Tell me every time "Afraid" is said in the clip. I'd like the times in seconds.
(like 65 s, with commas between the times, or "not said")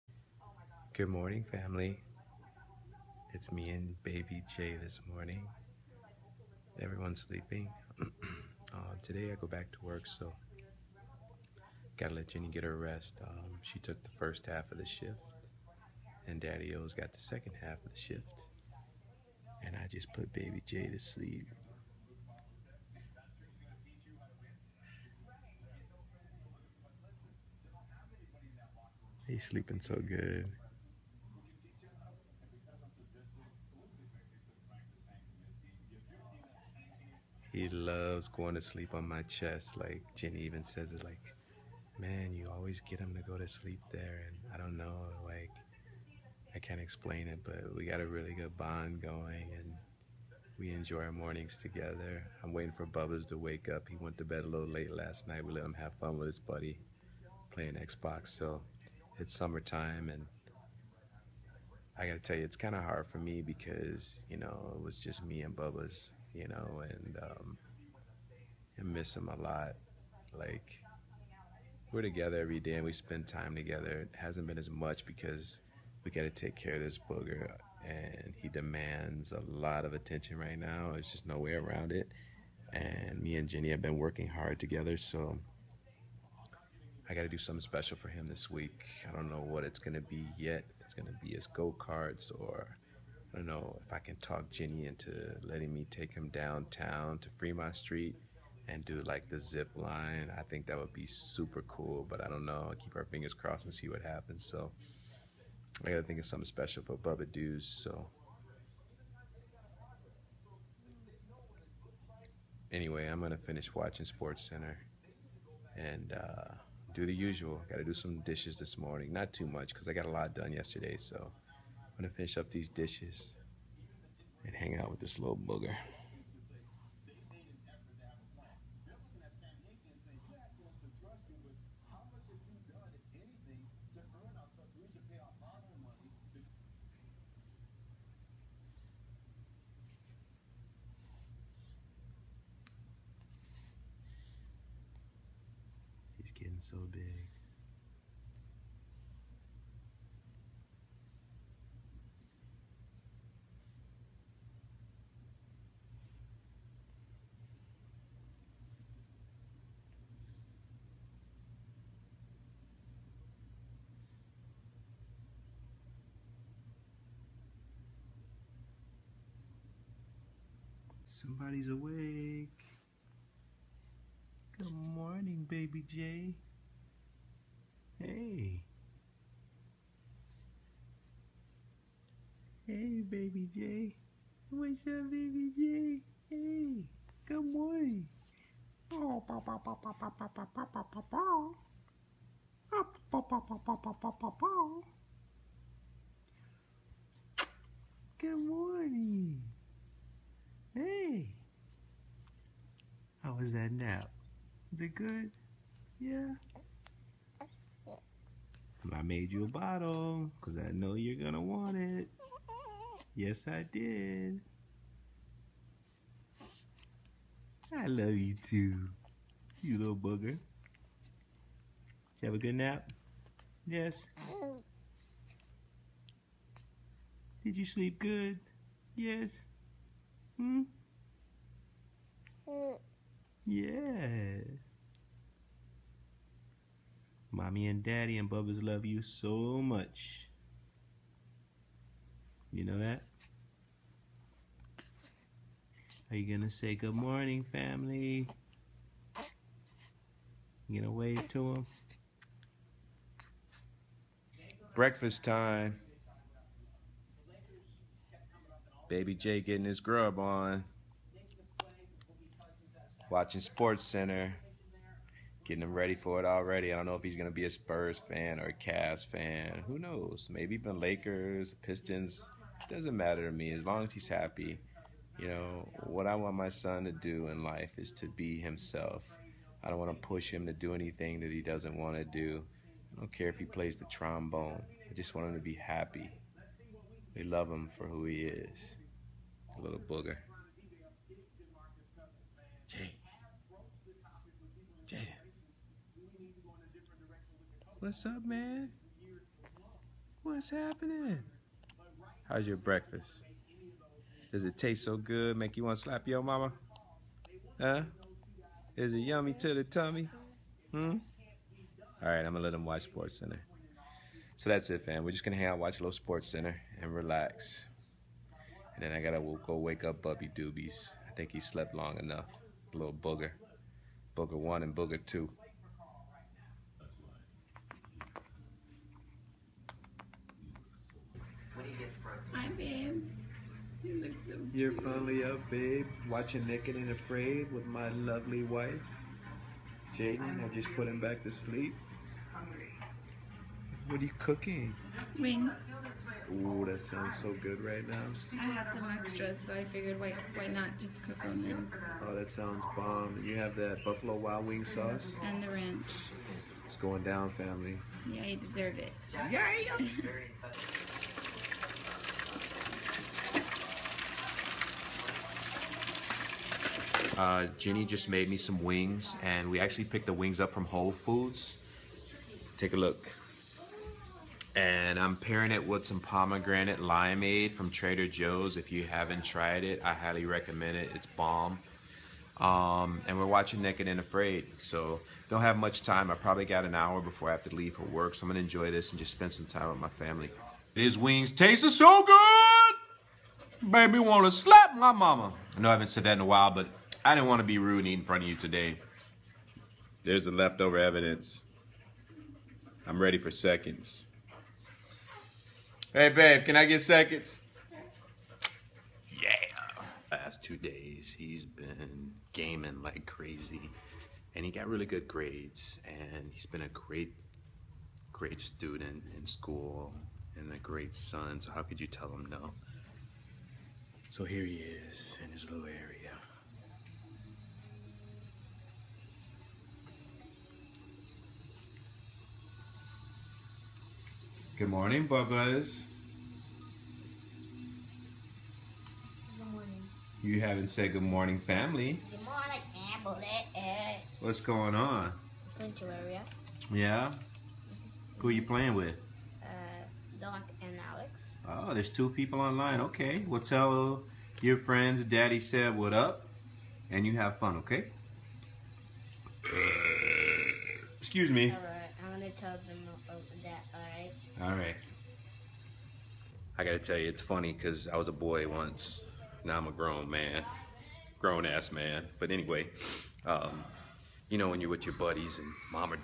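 336 s, 383 s.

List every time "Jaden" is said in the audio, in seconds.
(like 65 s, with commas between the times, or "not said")
294 s, 339 s.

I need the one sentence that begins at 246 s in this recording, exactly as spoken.
Are you going to say good morning, family?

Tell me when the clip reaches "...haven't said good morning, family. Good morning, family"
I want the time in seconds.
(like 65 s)
440 s.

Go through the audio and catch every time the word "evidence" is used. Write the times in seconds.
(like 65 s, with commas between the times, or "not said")
400 s.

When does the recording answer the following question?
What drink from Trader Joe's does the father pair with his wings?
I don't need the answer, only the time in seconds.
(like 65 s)
376 s.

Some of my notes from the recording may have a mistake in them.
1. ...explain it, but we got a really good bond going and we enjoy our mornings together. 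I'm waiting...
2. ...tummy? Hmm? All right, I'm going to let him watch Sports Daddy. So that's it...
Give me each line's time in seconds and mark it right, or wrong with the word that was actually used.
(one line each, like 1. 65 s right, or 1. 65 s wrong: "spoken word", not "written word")
1. 46 s right
2. 309 s wrong: "Center", not "Daddy".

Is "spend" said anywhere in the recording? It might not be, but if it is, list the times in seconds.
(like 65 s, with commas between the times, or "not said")
72 s, 389 s.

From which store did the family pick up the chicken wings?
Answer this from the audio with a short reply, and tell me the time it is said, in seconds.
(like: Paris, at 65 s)
Whole Foods, at 370 s.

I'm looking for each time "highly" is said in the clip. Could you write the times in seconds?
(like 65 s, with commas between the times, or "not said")
379 s.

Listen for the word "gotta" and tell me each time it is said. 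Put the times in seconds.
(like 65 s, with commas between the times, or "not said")
11 s, 62 s, 105 s, 319 s, 466 s.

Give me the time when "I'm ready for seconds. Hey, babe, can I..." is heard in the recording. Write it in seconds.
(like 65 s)
402 s.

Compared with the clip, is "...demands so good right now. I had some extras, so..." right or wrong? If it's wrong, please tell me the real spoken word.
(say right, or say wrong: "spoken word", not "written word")
wrong: "sounds", not "demands".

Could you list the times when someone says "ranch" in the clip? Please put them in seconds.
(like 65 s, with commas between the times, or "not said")
355 s.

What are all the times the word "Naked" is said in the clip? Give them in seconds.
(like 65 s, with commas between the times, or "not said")
336 s, 383 s.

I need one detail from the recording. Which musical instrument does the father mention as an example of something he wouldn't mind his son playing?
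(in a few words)
trombone.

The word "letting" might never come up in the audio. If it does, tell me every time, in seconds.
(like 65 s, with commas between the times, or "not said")
95 s.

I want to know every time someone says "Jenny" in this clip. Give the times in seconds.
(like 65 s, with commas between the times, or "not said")
12 s, 40 s, 83 s, 94 s.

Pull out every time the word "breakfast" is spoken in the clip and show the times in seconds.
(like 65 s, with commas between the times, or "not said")
254 s, 302 s.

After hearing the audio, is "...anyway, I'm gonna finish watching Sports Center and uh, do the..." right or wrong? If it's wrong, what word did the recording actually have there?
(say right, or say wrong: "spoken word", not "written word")
right.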